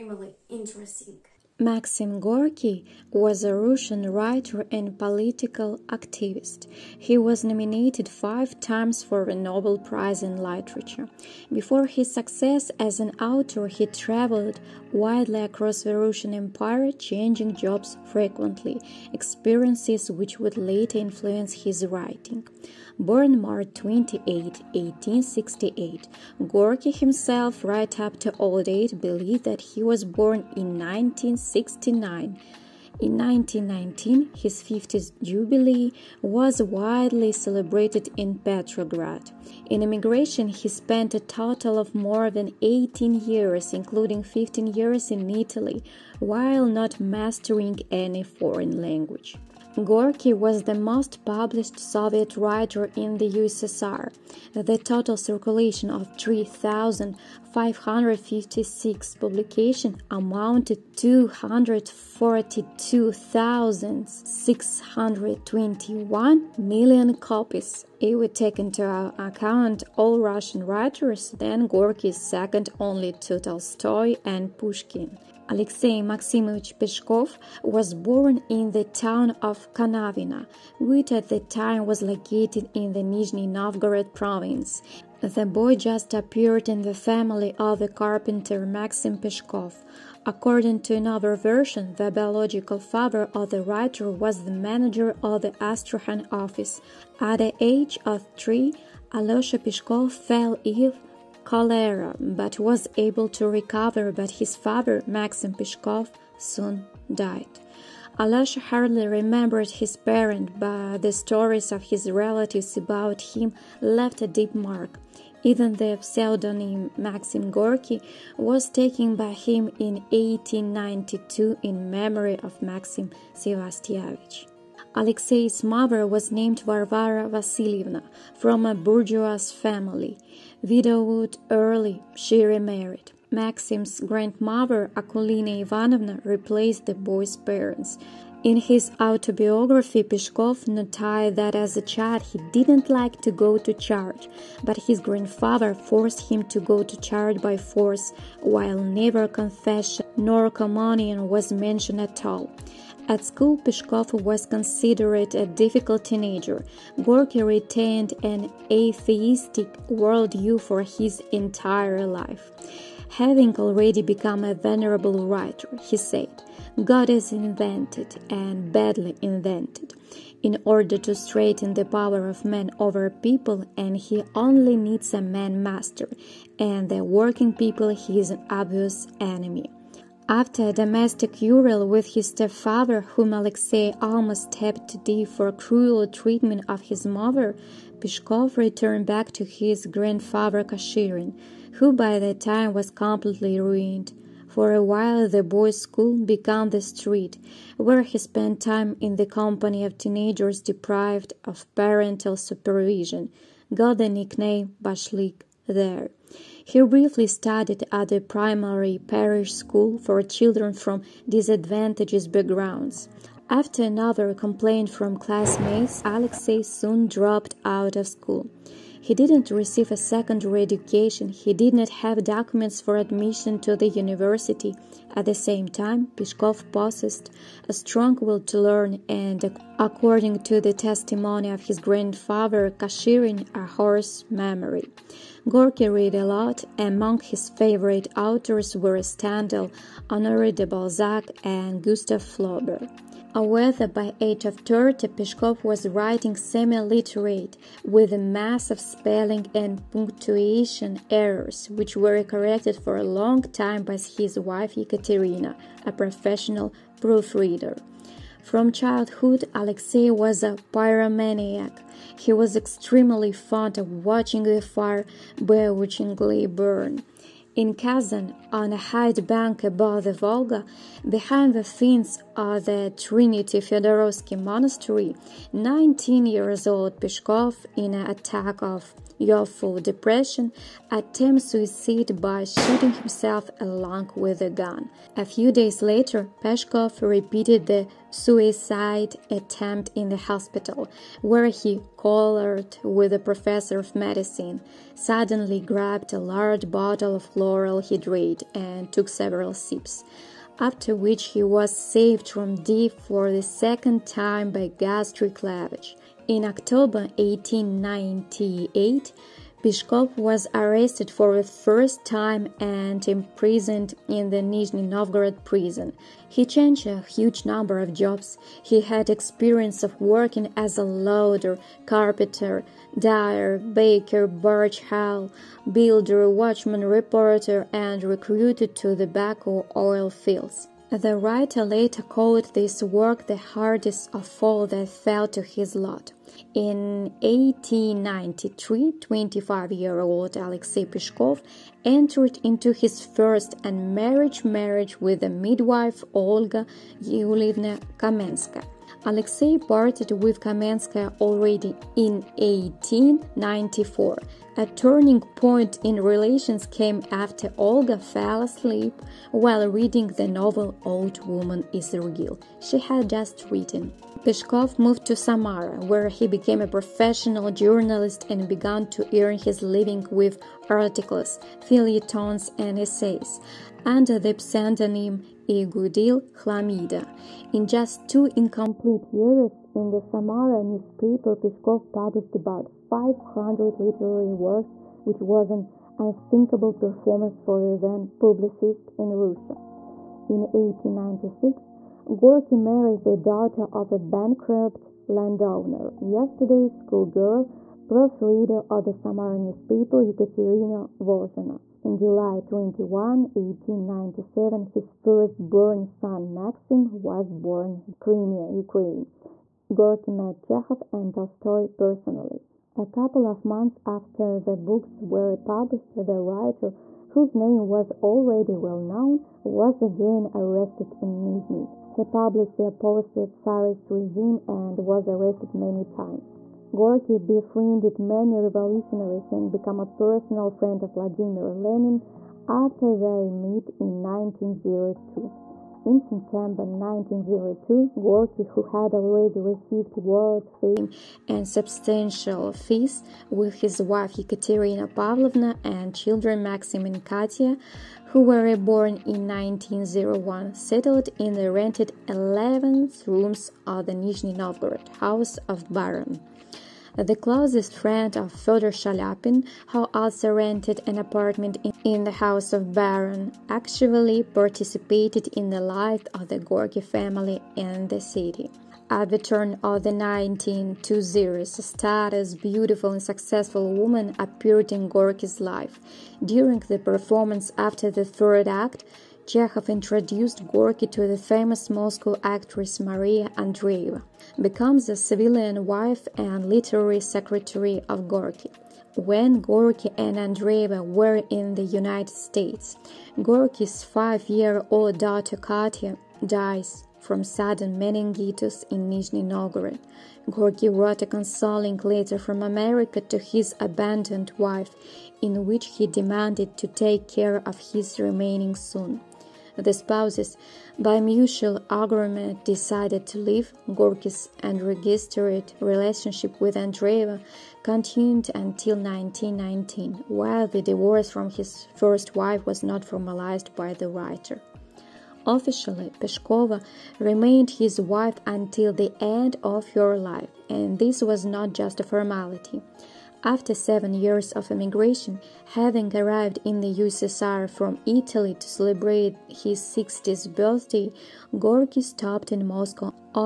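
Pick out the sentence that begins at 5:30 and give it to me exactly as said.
The writer later called this work the hardest of all that fell to his lot.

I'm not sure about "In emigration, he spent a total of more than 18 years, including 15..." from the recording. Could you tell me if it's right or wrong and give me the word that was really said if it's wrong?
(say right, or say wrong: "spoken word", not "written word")
right.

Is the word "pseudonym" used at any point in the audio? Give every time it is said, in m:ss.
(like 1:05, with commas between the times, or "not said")
1:55, 6:14.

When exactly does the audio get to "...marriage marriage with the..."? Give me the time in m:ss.
5:43.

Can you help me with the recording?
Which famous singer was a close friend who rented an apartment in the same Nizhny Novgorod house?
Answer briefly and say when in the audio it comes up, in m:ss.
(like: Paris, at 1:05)
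Fyodor Chaliapin, at 7:38.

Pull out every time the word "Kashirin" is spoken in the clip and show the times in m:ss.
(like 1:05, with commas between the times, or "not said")
3:10, 3:52.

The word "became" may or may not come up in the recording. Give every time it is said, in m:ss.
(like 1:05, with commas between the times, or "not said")
3:16, 6:06, 7:09.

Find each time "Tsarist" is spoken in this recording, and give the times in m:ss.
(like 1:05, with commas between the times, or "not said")
7:03.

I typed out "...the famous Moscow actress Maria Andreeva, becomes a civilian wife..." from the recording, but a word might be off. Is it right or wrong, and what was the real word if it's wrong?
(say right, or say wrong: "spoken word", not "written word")
right.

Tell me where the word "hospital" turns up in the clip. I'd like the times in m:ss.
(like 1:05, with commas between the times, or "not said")
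4:50.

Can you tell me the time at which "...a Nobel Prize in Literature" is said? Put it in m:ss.
0:09.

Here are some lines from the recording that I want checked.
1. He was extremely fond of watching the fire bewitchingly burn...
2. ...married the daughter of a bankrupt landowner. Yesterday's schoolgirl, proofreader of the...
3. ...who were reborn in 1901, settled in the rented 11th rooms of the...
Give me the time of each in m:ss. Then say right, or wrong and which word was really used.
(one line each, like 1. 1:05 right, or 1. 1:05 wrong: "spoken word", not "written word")
1. 4:22 right
2. 6:32 right
3. 7:28 right.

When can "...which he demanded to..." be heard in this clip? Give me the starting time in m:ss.
8:25.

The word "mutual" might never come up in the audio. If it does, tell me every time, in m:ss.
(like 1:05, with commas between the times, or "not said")
8:30.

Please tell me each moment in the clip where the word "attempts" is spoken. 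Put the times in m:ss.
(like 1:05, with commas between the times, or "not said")
4:40, 4:49.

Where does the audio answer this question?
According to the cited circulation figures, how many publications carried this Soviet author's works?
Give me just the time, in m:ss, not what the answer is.
0:56.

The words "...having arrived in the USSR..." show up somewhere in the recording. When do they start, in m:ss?
8:55.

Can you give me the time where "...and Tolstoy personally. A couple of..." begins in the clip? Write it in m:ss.
6:50.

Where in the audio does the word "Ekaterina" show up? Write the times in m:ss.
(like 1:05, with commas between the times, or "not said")
4:14, 6:40, 7:24.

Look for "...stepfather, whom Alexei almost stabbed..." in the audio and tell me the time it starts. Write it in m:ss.
3:02.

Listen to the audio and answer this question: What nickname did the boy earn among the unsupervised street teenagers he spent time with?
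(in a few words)
Bashlik.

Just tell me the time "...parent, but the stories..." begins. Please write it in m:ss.
1:49.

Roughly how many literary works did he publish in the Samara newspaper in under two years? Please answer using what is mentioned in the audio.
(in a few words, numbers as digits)
500.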